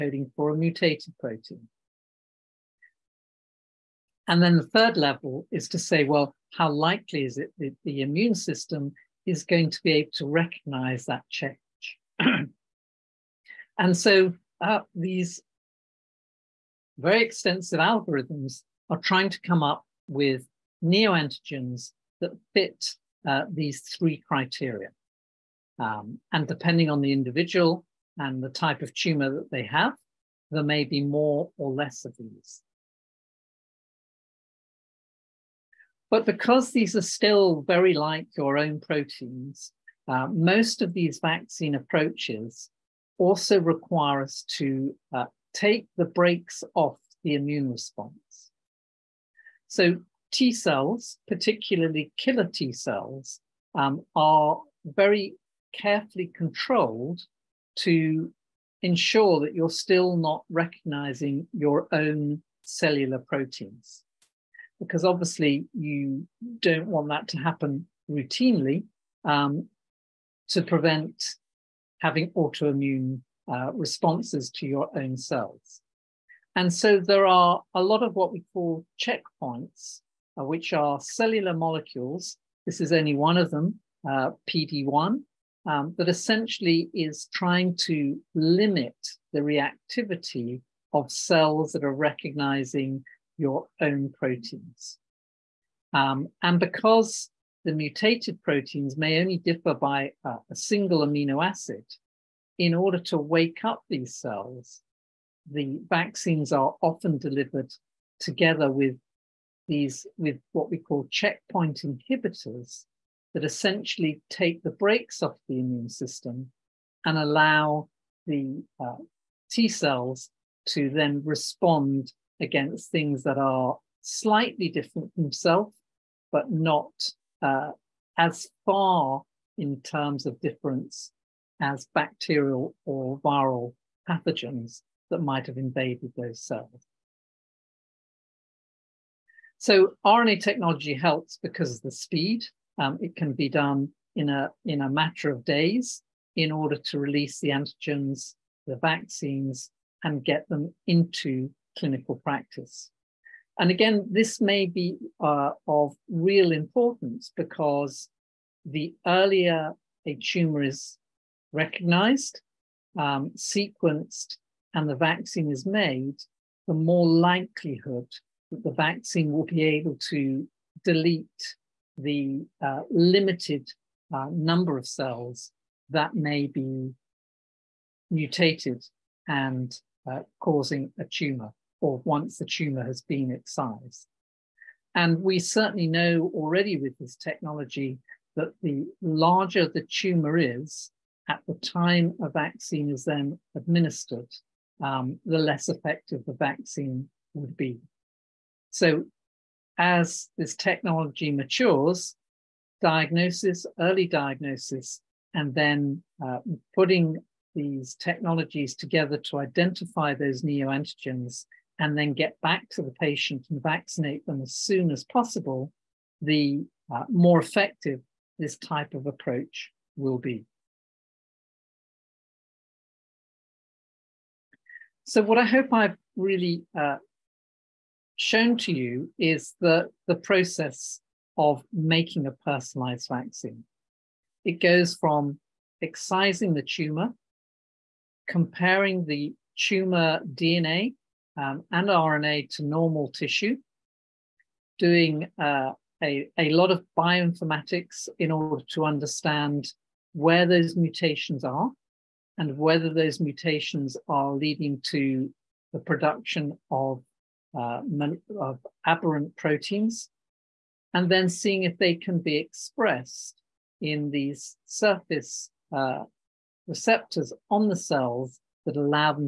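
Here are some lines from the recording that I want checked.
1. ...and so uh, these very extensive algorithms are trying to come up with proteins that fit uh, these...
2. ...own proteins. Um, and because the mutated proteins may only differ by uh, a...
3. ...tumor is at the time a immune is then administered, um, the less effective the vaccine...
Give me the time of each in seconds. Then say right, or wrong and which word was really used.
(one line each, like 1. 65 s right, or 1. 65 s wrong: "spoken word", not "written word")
1. 13 s wrong: "neoantigens", not "proteins"
2. 93 s right
3. 189 s wrong: "vaccine", not "immune".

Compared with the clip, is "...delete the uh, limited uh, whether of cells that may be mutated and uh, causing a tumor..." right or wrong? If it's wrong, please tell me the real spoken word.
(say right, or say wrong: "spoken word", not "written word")
wrong: "number", not "whether".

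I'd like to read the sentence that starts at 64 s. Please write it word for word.
Because obviously, you don't want that to happen routinely.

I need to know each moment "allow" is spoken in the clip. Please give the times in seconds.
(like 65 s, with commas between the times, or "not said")
117 s, 268 s.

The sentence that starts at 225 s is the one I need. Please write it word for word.
So what I hope I've really uh, shown to you is the, the process of making a personalized vaccine.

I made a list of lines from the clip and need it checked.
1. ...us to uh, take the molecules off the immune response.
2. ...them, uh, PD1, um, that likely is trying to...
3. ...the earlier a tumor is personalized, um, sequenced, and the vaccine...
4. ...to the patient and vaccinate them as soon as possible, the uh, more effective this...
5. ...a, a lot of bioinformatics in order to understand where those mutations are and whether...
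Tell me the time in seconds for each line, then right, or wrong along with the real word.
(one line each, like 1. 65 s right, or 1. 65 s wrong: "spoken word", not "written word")
1. 44 s wrong: "brakes", not "molecules"
2. 83 s wrong: "essentially", not "likely"
3. 158 s wrong: "recognized", not "personalized"
4. 212 s right
5. 246 s right.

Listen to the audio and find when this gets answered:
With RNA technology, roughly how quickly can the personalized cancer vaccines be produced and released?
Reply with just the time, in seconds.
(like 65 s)
144 s.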